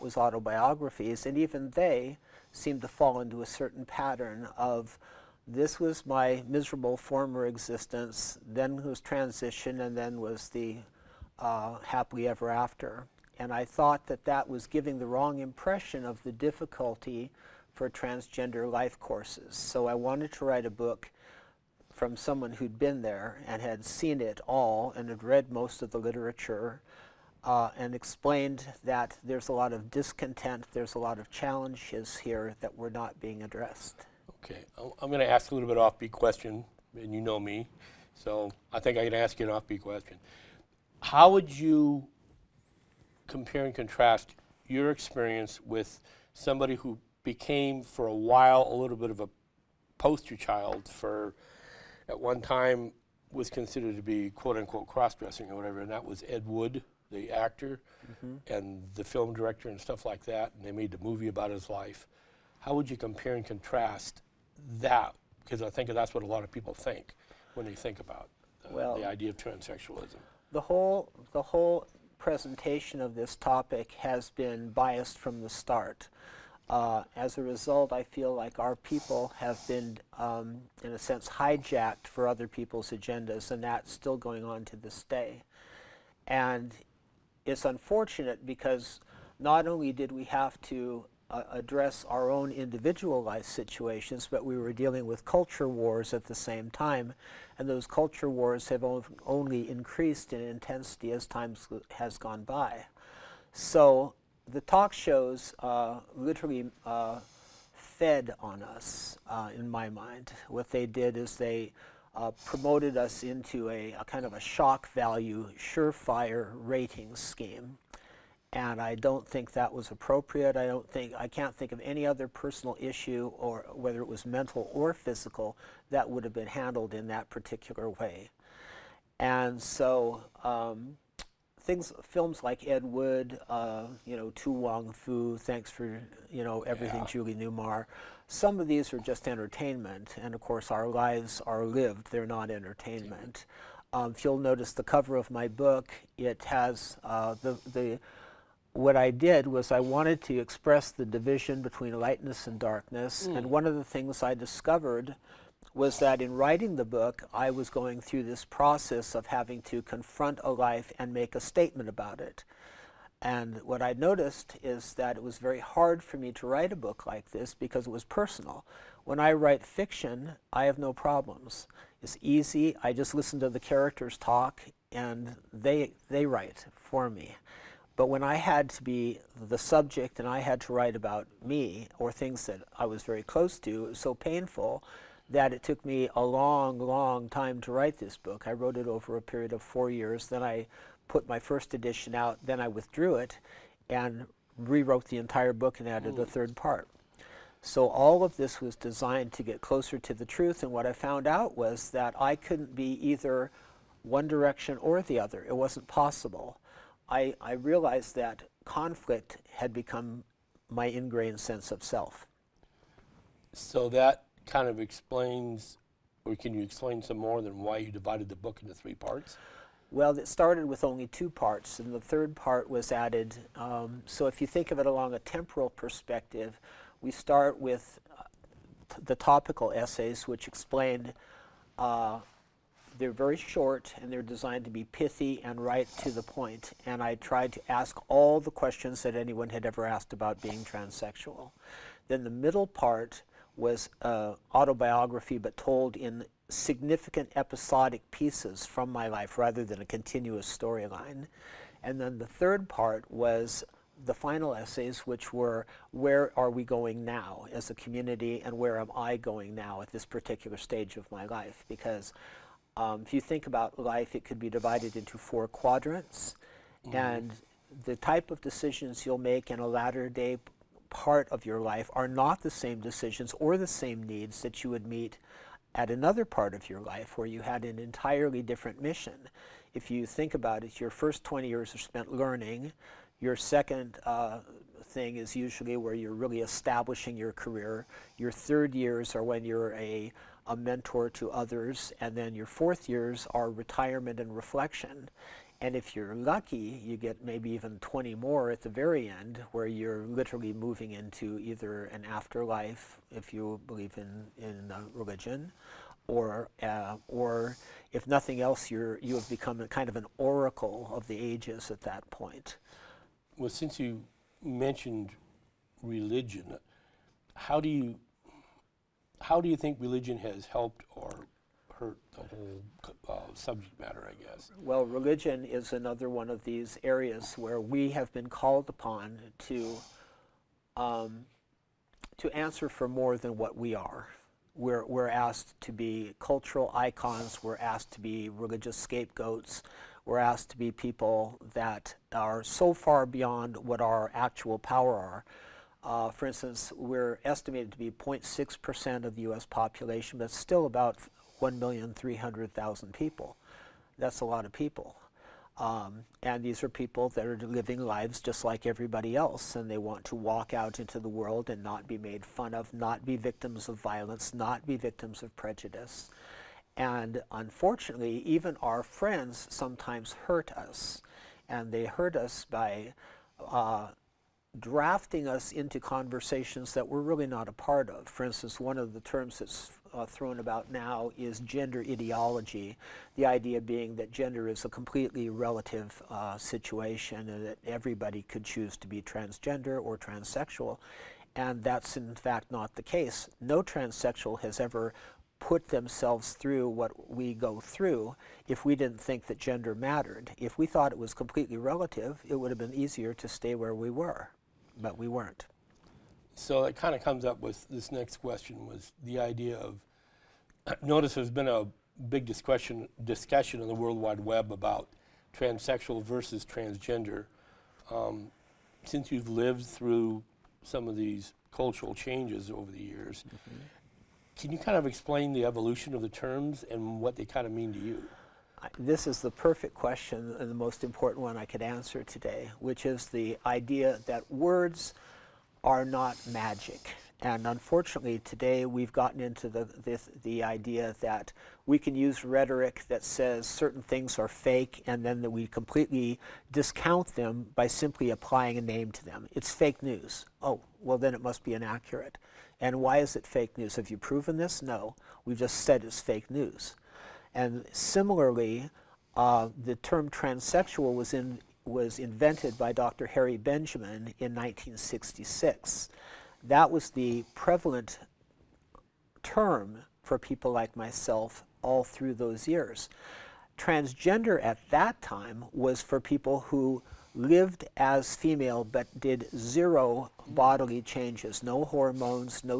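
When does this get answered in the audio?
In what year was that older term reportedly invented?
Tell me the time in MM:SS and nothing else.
07:44.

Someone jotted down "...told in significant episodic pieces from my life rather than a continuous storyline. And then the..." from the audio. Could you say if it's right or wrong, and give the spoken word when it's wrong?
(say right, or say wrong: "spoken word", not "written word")
right.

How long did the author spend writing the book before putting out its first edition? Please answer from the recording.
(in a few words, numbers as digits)
4 years.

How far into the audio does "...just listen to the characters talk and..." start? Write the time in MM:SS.
02:52.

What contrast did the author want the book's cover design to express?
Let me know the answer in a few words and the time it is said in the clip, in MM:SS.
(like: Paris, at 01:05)
Lightness and darkness, at 02:31.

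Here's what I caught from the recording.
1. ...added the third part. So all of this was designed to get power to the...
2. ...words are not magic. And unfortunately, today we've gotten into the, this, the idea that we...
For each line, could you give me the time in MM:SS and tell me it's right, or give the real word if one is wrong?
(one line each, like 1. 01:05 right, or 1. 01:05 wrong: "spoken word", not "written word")
1. 03:15 wrong: "closer", not "power"
2. 07:14 right.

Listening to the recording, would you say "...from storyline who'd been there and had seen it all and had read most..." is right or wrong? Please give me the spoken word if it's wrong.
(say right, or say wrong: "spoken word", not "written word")
wrong: "someone", not "storyline".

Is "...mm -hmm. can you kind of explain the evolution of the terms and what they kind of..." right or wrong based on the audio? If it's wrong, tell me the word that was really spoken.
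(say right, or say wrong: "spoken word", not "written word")
right.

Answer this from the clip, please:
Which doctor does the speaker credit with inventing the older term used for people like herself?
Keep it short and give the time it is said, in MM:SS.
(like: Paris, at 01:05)
Dr. Harry Benjamin, at 07:42.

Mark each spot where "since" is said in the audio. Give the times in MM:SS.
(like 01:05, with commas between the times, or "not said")
05:13, 06:58.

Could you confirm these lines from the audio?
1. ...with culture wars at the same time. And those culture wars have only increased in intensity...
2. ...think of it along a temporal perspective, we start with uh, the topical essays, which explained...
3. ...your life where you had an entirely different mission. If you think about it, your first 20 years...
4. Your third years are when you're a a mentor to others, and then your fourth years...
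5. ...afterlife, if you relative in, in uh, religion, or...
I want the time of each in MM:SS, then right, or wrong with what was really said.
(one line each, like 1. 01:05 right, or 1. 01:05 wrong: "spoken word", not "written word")
1. 01:35 right
2. 03:44 right
3. 04:36 right
4. 04:48 right
5. 05:02 wrong: "believe", not "relative".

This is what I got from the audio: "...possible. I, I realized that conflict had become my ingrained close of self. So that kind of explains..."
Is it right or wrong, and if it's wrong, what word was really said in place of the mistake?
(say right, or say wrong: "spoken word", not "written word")
wrong: "sense", not "close".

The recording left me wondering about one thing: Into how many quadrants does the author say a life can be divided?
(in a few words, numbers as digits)
4.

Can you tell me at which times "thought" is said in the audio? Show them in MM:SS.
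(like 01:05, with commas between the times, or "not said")
00:13, 06:40.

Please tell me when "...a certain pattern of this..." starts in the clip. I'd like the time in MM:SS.
00:03.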